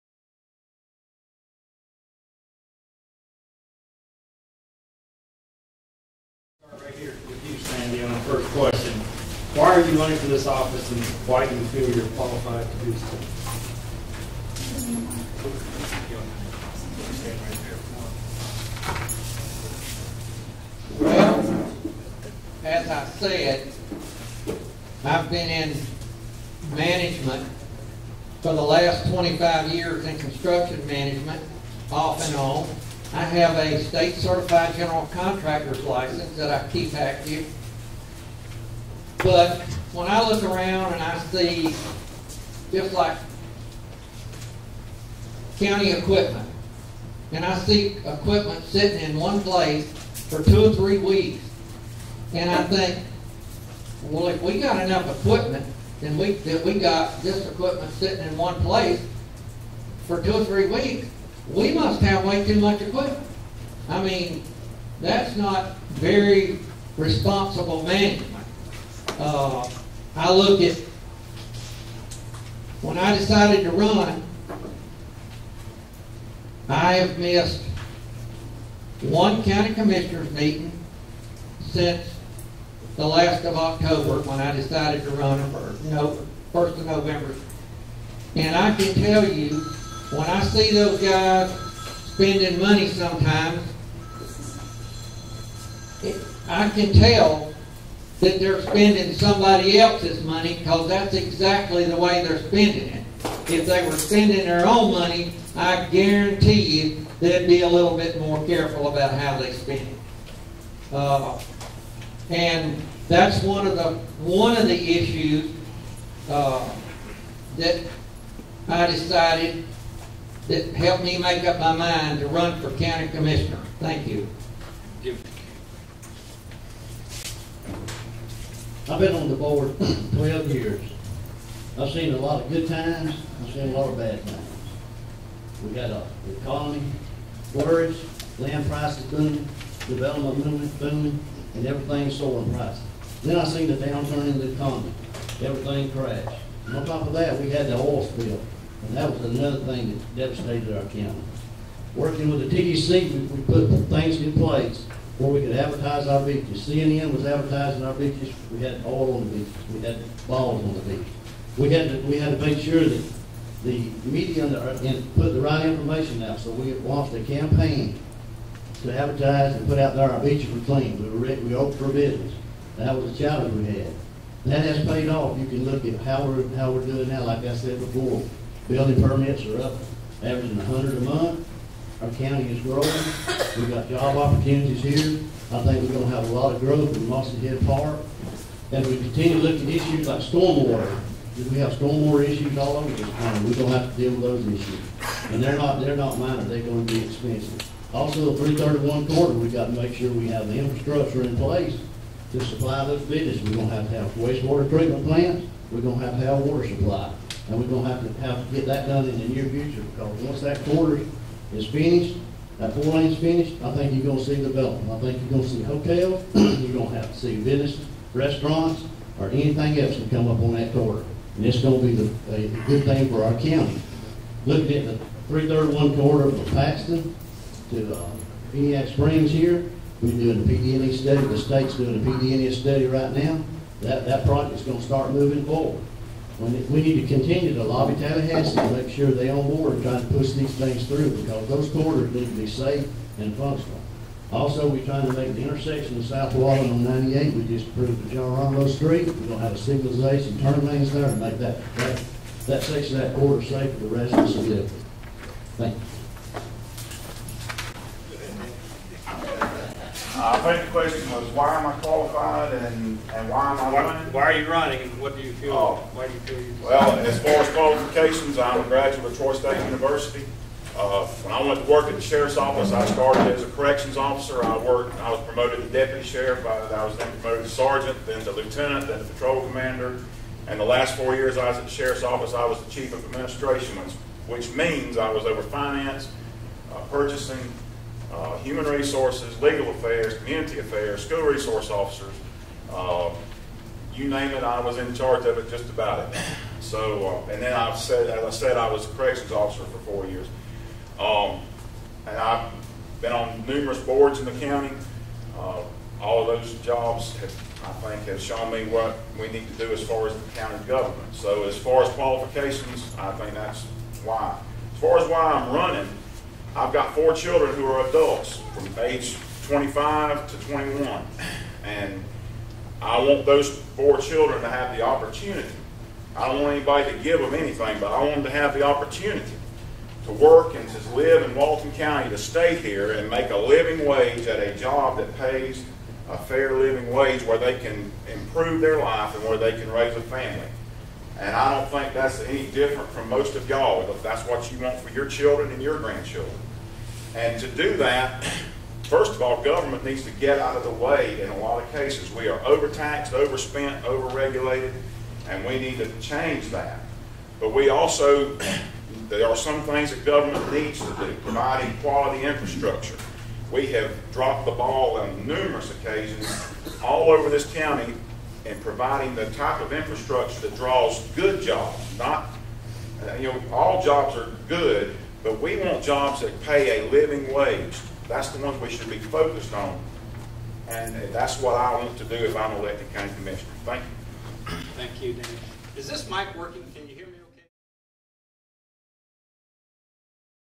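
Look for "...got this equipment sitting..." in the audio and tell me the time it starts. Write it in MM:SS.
00:56.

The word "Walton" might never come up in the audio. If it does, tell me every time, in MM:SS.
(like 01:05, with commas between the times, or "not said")
04:06, 05:31.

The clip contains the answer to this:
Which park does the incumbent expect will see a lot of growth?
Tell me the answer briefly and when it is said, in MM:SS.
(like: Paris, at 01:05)
Mossy Head Park, at 03:07.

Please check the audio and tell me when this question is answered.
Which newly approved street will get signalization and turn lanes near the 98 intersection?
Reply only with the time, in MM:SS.
04:08.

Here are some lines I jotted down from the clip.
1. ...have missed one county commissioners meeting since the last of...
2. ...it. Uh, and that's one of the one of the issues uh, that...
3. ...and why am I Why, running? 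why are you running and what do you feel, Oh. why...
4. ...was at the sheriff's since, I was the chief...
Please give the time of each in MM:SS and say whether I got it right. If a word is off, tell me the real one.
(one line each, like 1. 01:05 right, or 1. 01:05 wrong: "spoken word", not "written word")
1. 01:16 right
2. 01:49 right
3. 04:23 right
4. 04:41 wrong: "office", not "since".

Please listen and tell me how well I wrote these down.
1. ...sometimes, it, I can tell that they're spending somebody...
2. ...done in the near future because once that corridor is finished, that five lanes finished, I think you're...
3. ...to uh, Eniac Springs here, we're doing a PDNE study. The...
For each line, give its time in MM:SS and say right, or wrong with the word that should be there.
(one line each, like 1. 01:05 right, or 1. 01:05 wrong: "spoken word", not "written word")
1. 01:32 right
2. 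03:28 wrong: "four", not "five"
3. 03:47 right.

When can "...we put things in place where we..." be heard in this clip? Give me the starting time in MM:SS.
02:33.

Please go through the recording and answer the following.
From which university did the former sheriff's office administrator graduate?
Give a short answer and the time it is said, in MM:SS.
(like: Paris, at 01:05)
Troy State University, at 04:29.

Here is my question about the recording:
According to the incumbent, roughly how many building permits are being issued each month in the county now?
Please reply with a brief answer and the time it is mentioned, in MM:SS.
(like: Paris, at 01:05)
100, at 03:00.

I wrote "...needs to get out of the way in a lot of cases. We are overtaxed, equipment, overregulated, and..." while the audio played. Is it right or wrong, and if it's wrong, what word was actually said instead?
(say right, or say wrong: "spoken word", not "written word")
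wrong: "overspent", not "equipment".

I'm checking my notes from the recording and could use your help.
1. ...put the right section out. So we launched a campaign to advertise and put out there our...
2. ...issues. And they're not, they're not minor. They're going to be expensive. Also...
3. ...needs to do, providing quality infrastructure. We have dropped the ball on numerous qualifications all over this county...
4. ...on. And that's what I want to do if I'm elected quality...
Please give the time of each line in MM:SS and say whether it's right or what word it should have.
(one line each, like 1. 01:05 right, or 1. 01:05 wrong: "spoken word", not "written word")
1. 02:45 wrong: "information", not "section"
2. 03:14 right
3. 06:00 wrong: "occasions", not "qualifications"
4. 06:19 wrong: "county", not "quality".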